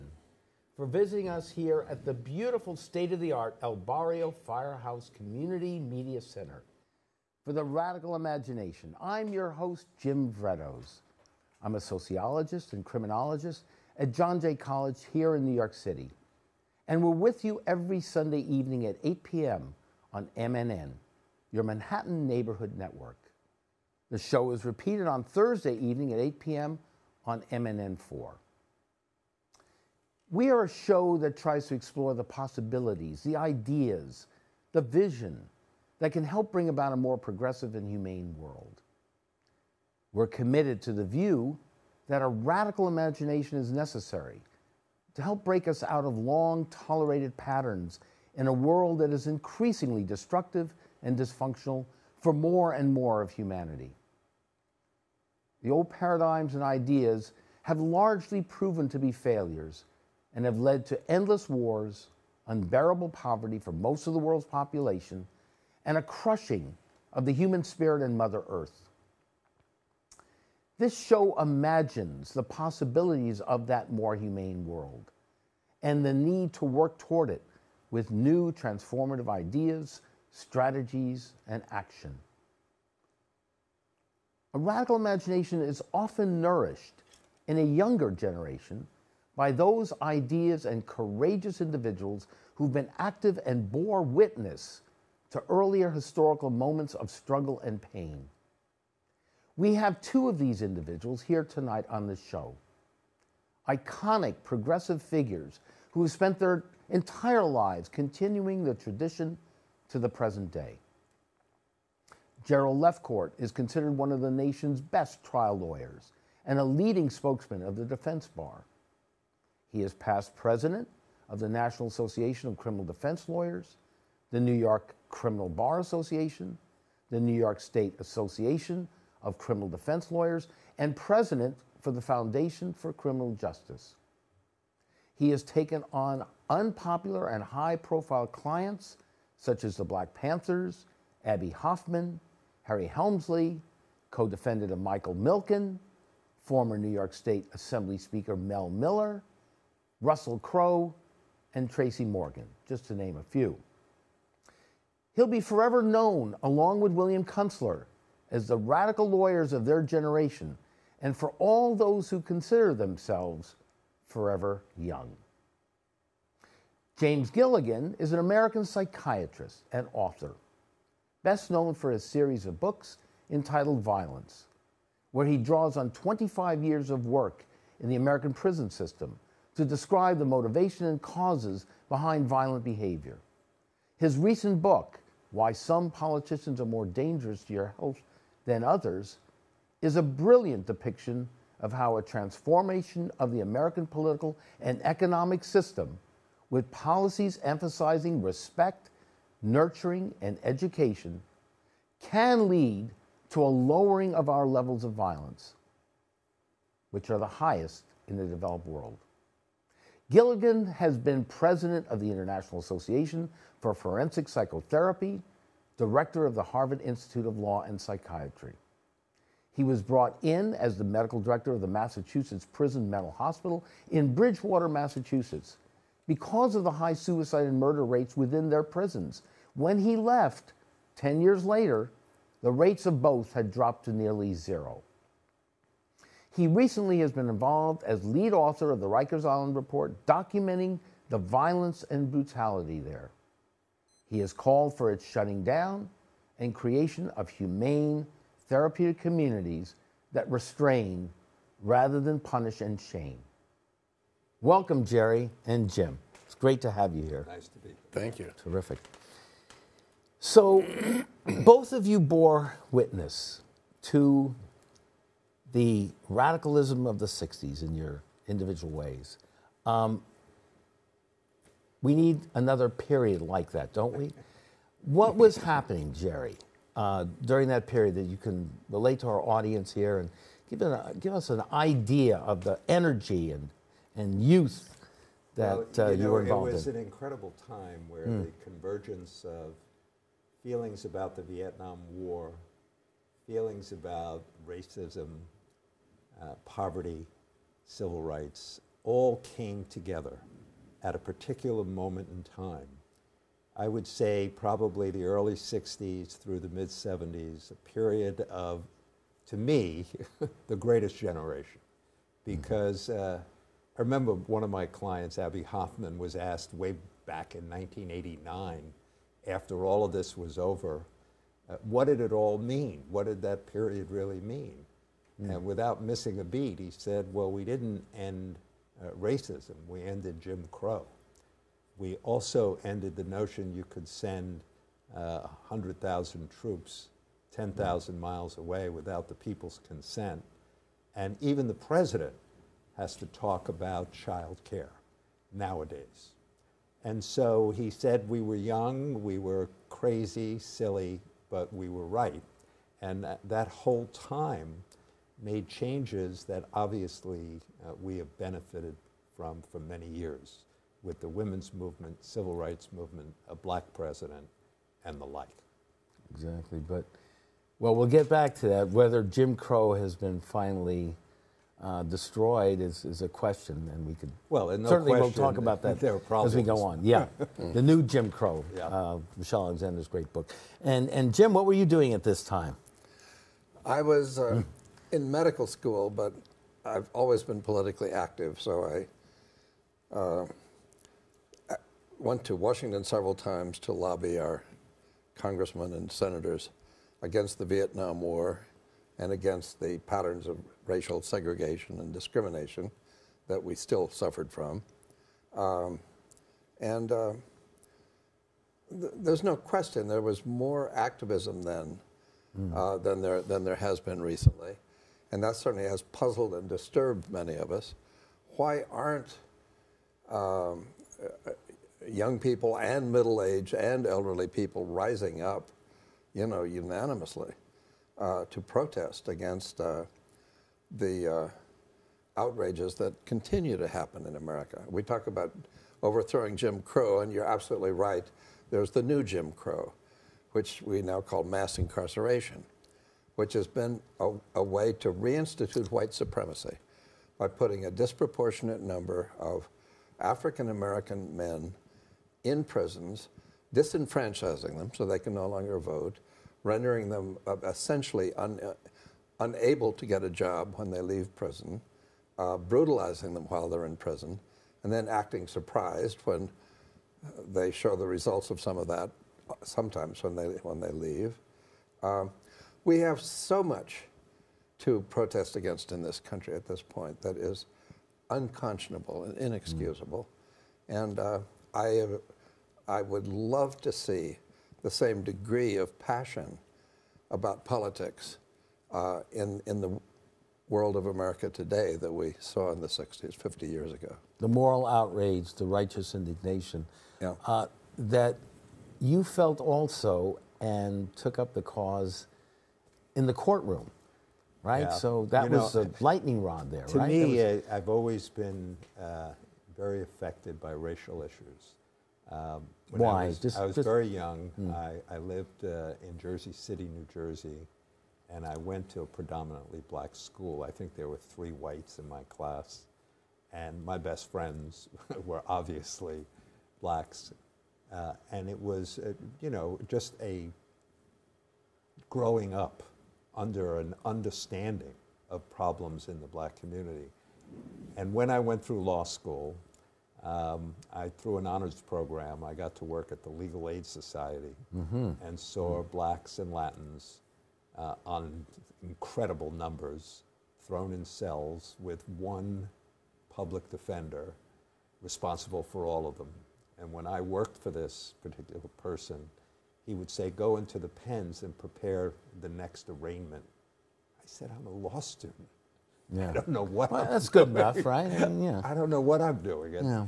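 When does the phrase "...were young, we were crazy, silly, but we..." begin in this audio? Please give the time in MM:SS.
05:48.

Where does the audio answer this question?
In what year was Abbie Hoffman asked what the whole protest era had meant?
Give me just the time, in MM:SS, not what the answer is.
05:17.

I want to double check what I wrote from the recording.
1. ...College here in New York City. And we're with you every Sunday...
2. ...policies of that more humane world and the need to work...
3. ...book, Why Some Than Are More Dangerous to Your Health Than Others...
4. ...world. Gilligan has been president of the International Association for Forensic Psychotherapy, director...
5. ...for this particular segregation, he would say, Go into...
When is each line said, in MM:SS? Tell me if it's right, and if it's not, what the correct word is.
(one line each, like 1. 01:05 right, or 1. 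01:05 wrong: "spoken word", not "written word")
1. 00:14 right
2. 01:12 wrong: "possibilities", not "policies"
3. 03:04 wrong: "Politicians", not "Than"
4. 03:28 right
5. 09:17 wrong: "person", not "segregation".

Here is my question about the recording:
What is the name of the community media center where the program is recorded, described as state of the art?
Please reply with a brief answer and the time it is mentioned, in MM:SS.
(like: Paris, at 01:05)
El Barrio Firehouse Community Media Center, at 00:03.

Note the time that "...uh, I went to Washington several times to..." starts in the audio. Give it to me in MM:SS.
06:29.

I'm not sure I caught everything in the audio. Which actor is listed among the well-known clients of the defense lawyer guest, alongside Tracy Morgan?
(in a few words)
Russell Crowe.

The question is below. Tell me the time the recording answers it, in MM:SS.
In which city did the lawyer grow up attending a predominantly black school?
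08:35.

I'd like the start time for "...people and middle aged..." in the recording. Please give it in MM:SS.
07:02.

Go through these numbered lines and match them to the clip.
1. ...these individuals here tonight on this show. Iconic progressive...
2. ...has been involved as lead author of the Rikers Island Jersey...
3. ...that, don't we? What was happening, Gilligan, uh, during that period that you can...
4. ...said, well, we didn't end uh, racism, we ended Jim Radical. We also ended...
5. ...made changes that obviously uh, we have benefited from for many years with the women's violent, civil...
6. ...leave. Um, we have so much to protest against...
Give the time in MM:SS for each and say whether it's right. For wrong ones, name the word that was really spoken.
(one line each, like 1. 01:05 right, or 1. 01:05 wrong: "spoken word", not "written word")
1. 01:40 right
2. 03:56 wrong: "Report", not "Jersey"
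3. 04:33 wrong: "Jerry", not "Gilligan"
4. 05:26 wrong: "Crow", not "Radical"
5. 05:55 wrong: "movement", not "violent"
6. 07:50 right.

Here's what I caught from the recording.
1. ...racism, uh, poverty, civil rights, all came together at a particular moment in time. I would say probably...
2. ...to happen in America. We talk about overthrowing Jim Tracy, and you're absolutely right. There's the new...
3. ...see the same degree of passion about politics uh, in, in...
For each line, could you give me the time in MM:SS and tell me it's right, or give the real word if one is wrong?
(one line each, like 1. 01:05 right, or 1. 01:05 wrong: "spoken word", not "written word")
1. 04:54 right
2. 07:13 wrong: "Crow", not "Tracy"
3. 08:03 right.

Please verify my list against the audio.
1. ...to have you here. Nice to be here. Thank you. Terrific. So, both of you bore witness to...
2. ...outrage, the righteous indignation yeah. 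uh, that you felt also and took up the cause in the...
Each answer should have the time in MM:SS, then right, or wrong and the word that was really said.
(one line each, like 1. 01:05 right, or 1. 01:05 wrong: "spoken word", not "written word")
1. 04:16 right
2. 08:14 right.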